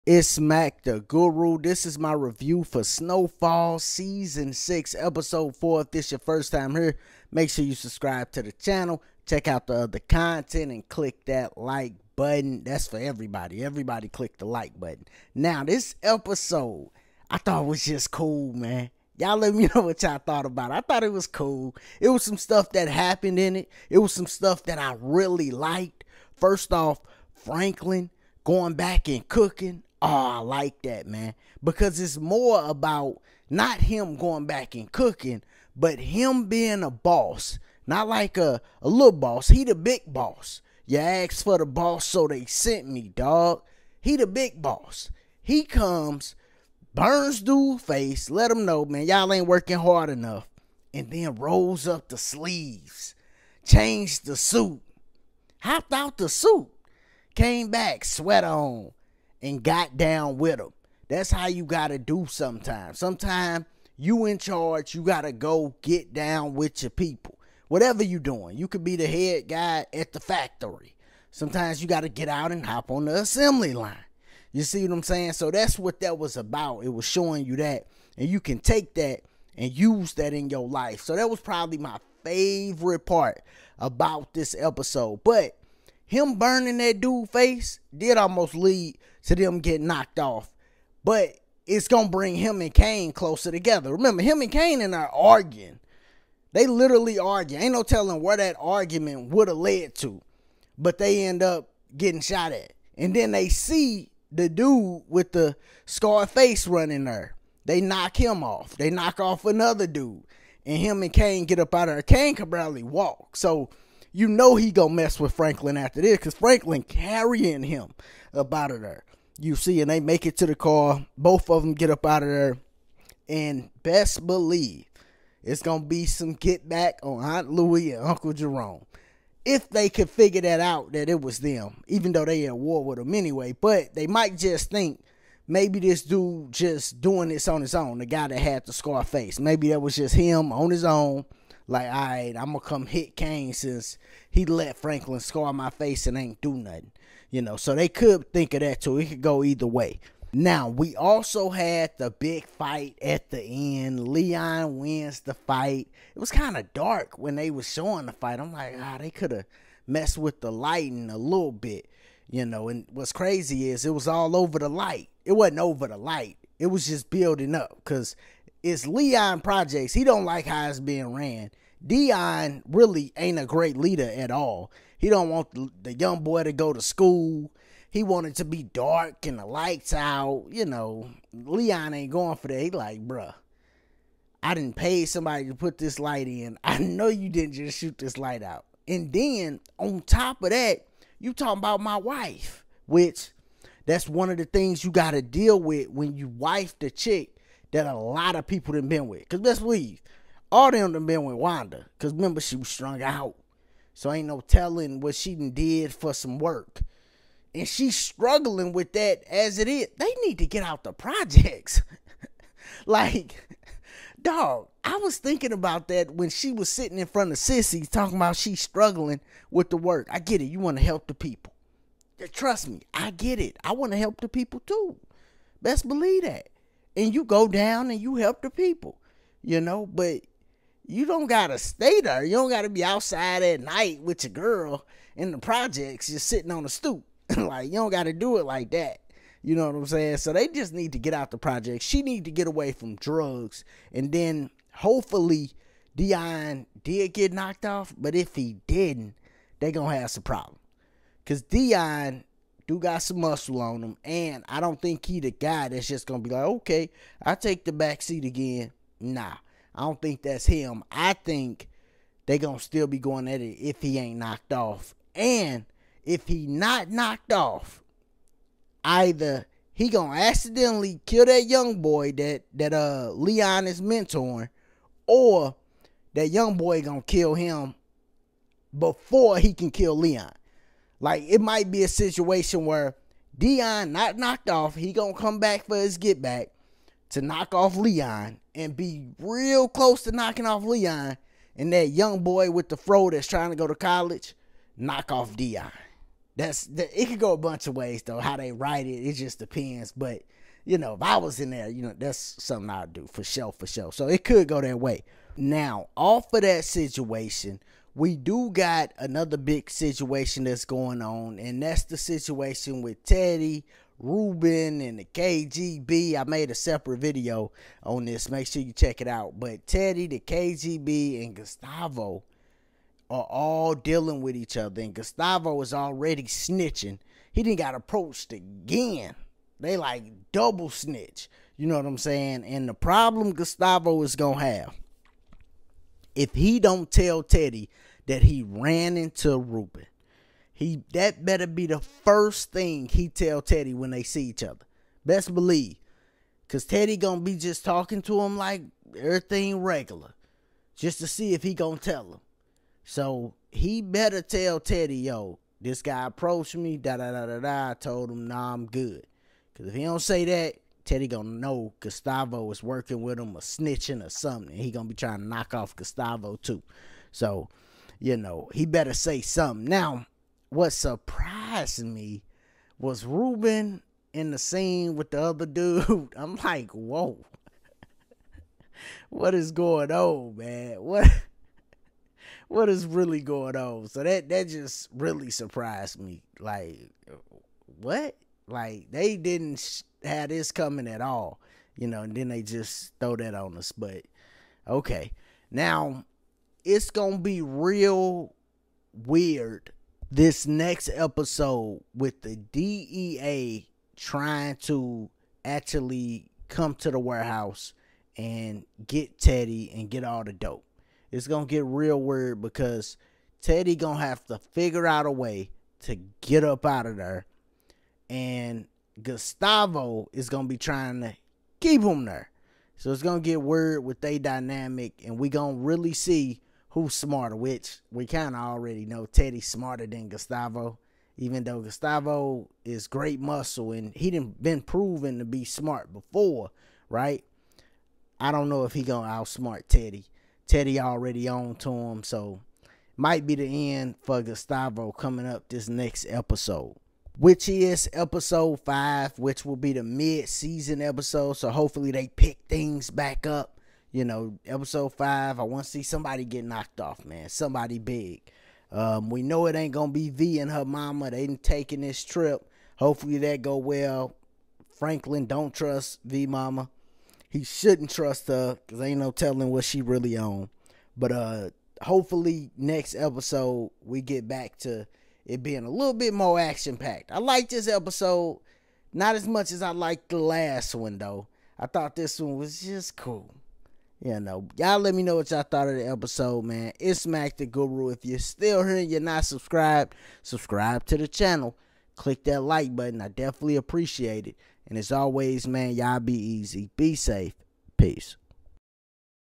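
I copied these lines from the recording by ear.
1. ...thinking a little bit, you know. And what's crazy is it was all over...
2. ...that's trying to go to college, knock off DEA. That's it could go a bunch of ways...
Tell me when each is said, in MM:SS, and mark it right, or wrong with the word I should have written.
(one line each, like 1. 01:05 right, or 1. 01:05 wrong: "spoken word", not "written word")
1. 02:40 wrong: "lighting", not "thinking"
2. 04:53 wrong: "Dion", not "DEA".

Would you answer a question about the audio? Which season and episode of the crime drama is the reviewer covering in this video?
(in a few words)
Season 6, Episode 4.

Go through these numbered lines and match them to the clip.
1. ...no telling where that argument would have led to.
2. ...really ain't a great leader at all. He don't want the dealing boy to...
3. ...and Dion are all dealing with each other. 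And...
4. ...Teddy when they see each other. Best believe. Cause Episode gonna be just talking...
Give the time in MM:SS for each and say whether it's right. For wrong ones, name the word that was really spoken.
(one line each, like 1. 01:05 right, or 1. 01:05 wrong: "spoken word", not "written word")
1. 01:37 right
2. 02:52 wrong: "young", not "dealing"
3. 05:21 wrong: "Gustavo", not "Dion"
4. 05:43 wrong: "Teddy", not "Episode".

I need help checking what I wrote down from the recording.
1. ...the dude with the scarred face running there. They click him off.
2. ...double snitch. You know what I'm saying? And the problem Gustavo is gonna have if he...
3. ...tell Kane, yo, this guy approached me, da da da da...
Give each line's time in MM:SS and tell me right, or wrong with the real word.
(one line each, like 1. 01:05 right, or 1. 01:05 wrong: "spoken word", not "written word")
1. 01:44 wrong: "knock", not "click"
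2. 05:30 right
3. 05:54 wrong: "Teddy", not "Kane".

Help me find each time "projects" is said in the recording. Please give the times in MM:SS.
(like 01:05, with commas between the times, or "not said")
02:49, 03:30, 03:55, 04:01.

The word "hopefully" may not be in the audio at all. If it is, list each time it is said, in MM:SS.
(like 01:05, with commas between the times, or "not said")
04:04, 07:31, 07:42, 07:51.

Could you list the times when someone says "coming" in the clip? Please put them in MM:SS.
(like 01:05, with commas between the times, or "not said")
06:30, 07:24.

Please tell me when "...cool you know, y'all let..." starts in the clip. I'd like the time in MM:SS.
08:02.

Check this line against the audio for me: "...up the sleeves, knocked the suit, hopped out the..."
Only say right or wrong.
wrong.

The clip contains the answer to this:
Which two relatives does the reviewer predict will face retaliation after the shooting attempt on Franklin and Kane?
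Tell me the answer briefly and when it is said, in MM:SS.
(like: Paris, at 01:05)
Aunt Louie and Uncle Jerome, at 02:07.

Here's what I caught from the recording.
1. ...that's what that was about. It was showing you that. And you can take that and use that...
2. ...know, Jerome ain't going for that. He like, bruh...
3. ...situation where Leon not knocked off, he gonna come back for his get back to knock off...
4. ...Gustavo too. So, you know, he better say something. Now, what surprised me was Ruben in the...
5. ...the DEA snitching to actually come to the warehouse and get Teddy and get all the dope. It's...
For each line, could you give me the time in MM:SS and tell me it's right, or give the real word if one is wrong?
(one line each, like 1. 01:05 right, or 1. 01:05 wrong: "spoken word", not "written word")
1. 01:15 right
2. 03:00 wrong: "Leon", not "Jerome"
3. 04:41 wrong: "Dion", not "Leon"
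4. 06:05 right
5. 06:42 wrong: "trying", not "snitching".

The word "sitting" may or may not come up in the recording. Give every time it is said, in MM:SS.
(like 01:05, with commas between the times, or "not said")
03:36, 03:56.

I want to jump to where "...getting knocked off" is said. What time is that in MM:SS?
01:29.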